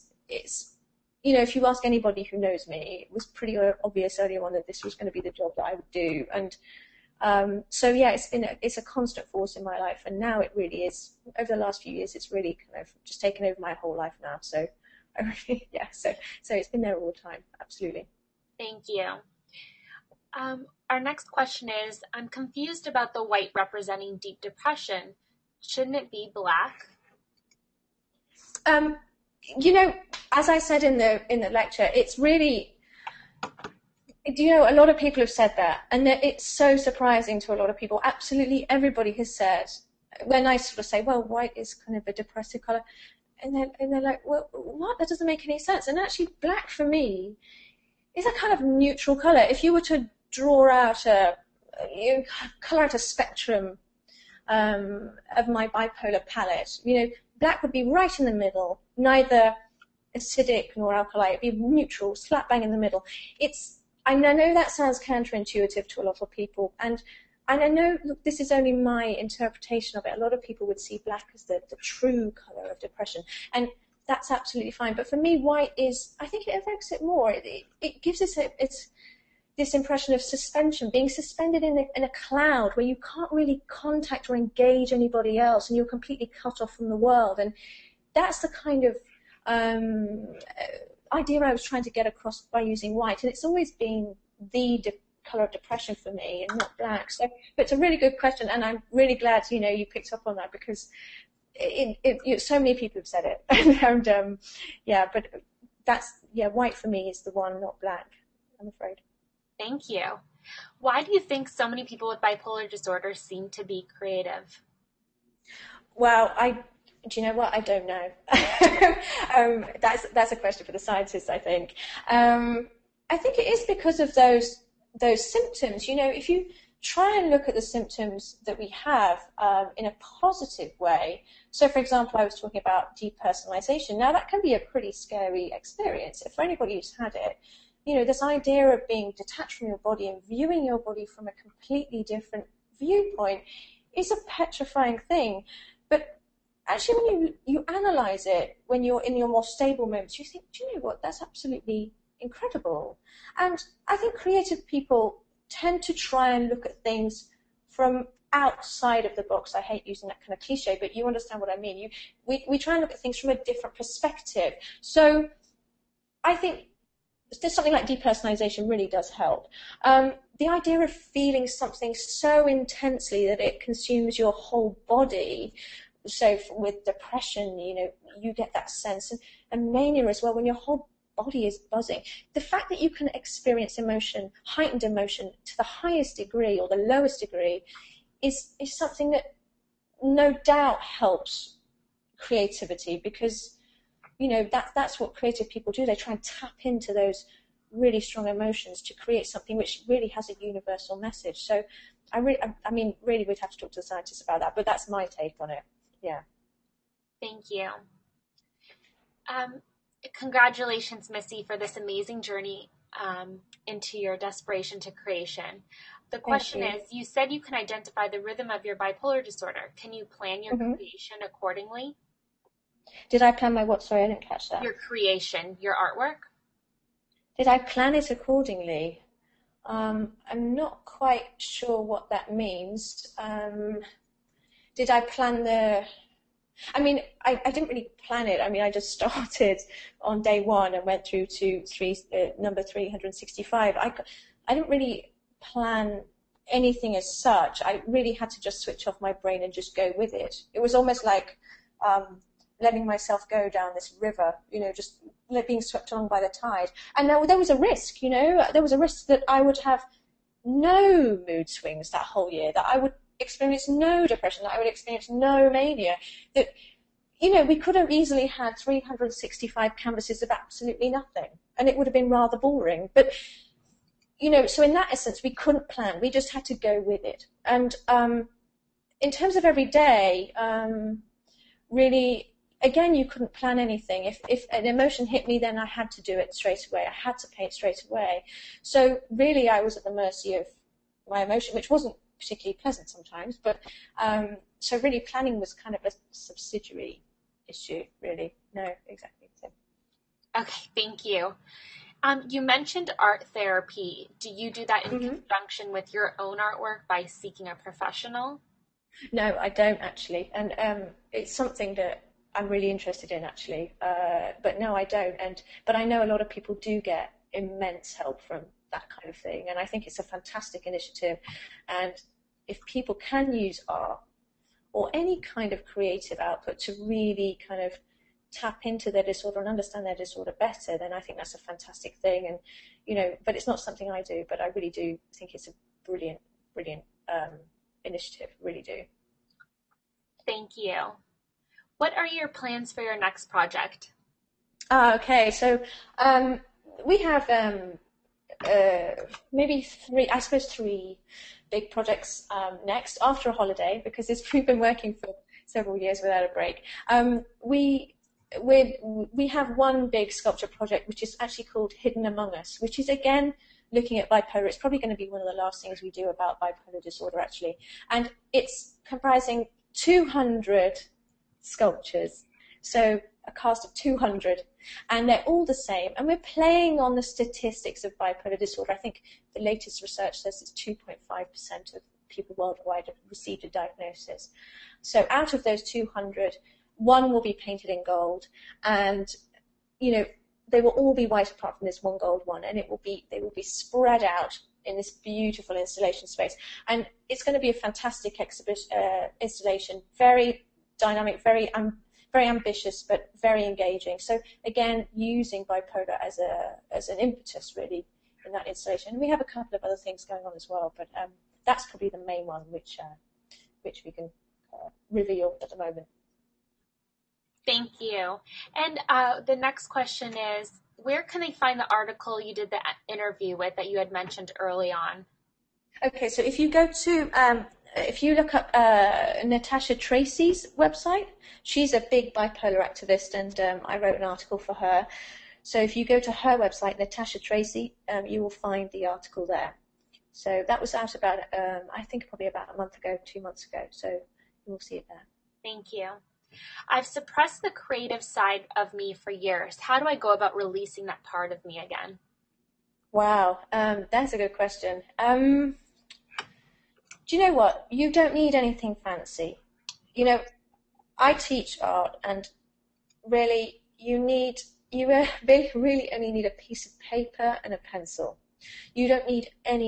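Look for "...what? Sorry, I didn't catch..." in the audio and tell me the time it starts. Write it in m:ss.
3:43.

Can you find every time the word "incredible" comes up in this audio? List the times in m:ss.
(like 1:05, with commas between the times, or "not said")
2:32.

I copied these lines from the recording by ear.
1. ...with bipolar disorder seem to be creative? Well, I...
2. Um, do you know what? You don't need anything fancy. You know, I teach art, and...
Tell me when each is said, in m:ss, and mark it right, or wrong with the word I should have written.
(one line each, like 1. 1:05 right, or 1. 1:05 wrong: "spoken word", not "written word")
1. 1:52 right
2. 7:34 right.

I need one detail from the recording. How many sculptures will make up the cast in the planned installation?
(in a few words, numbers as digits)
200.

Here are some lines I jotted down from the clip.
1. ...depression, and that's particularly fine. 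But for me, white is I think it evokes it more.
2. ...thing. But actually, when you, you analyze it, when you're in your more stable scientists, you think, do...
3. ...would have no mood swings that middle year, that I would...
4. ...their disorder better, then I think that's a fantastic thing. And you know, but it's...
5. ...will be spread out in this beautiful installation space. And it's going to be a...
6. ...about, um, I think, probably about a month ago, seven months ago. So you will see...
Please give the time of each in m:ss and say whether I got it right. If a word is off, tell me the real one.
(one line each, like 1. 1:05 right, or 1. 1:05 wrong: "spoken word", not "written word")
1. 1:12 wrong: "absolutely", not "particularly"
2. 2:25 wrong: "moments", not "scientists"
3. 4:19 wrong: "whole", not "middle"
4. 5:29 right
5. 6:33 right
6. 7:20 wrong: "two", not "seven".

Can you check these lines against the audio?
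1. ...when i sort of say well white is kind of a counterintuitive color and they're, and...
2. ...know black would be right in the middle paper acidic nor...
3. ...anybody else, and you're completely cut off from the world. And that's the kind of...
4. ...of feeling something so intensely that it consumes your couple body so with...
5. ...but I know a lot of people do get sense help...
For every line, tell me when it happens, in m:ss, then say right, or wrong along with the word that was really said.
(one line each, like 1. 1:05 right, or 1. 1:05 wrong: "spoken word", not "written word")
1. 0:40 wrong: "depressive", not "counterintuitive"
2. 0:57 wrong: "neither", not "paper"
3. 1:24 right
4. 2:50 wrong: "whole", not "couple"
5. 5:15 wrong: "immense", not "sense".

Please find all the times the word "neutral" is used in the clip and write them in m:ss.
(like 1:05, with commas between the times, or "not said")
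0:48, 1:01.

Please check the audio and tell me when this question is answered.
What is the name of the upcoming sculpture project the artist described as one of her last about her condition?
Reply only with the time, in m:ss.
6:01.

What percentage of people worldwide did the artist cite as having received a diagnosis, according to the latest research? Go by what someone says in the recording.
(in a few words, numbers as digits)
2.5%.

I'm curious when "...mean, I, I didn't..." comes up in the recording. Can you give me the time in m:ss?
3:56.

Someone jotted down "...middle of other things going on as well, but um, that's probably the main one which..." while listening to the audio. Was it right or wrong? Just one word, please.
wrong.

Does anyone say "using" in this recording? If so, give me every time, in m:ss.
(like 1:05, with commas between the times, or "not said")
1:32, 2:39, 6:44.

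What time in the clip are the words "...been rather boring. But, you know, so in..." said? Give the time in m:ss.
4:31.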